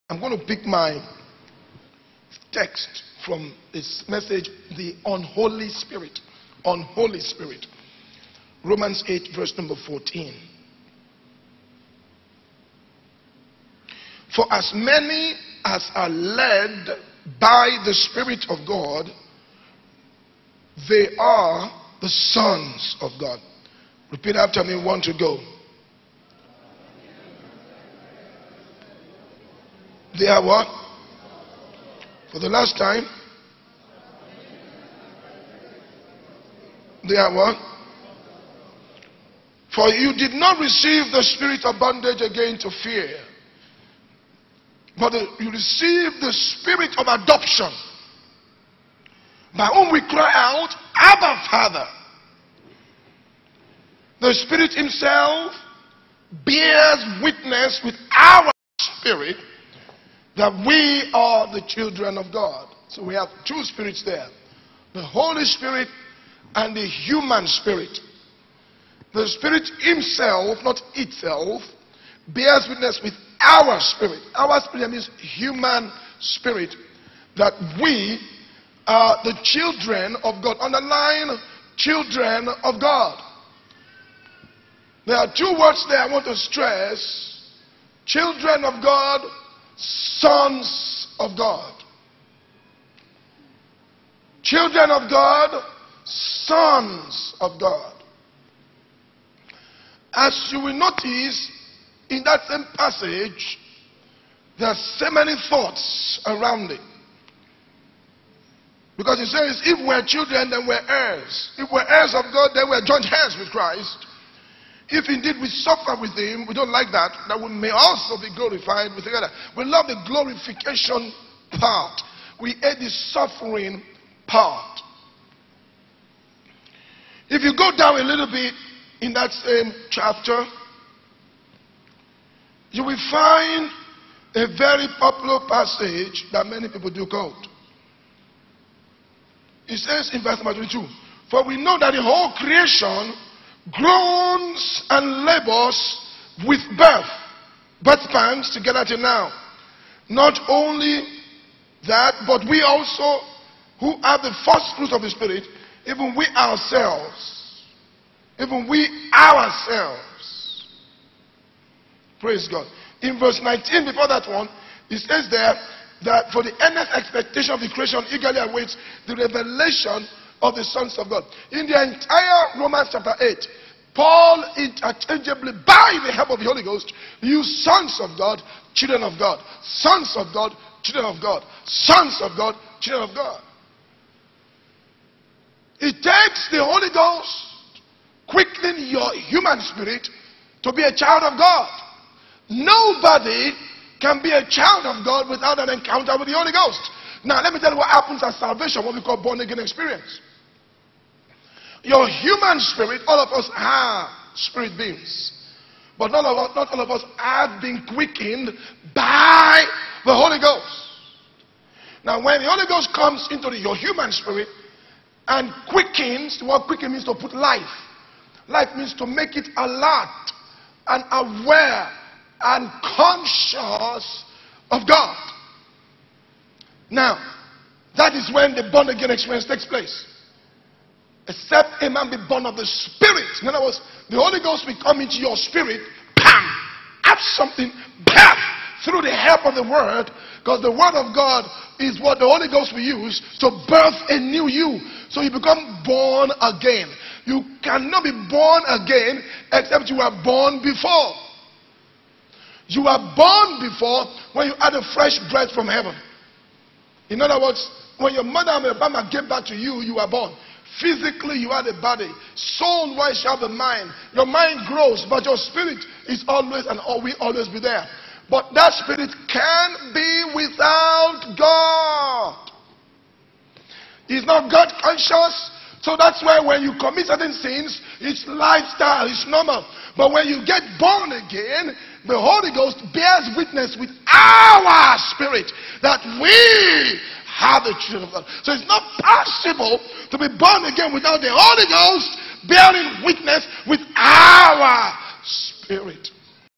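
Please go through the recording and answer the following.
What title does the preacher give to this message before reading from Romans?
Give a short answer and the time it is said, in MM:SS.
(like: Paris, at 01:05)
The Unholy Spirit, at 00:04.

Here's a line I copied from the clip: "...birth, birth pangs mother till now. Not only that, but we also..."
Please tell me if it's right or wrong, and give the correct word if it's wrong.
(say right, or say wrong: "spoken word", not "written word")
wrong: "together", not "mother".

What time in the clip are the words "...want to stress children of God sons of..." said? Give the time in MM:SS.
01:26.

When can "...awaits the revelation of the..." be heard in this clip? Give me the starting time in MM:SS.
02:48.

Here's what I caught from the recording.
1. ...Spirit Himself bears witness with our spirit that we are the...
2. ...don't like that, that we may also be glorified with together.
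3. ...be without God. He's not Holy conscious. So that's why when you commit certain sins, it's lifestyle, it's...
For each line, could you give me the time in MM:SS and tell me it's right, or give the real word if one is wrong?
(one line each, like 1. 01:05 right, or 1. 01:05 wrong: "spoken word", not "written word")
1. 00:54 right
2. 01:56 right
3. 04:29 wrong: "God", not "Holy".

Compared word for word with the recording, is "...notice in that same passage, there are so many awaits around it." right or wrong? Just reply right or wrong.
wrong.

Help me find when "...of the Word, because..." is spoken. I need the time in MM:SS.
03:59.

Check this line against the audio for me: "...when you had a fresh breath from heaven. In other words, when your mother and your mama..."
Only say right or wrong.
right.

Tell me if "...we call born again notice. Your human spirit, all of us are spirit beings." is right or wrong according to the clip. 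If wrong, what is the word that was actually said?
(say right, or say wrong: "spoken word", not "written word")
wrong: "experience", not "notice".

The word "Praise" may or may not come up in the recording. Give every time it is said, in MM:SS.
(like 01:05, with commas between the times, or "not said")
02:42.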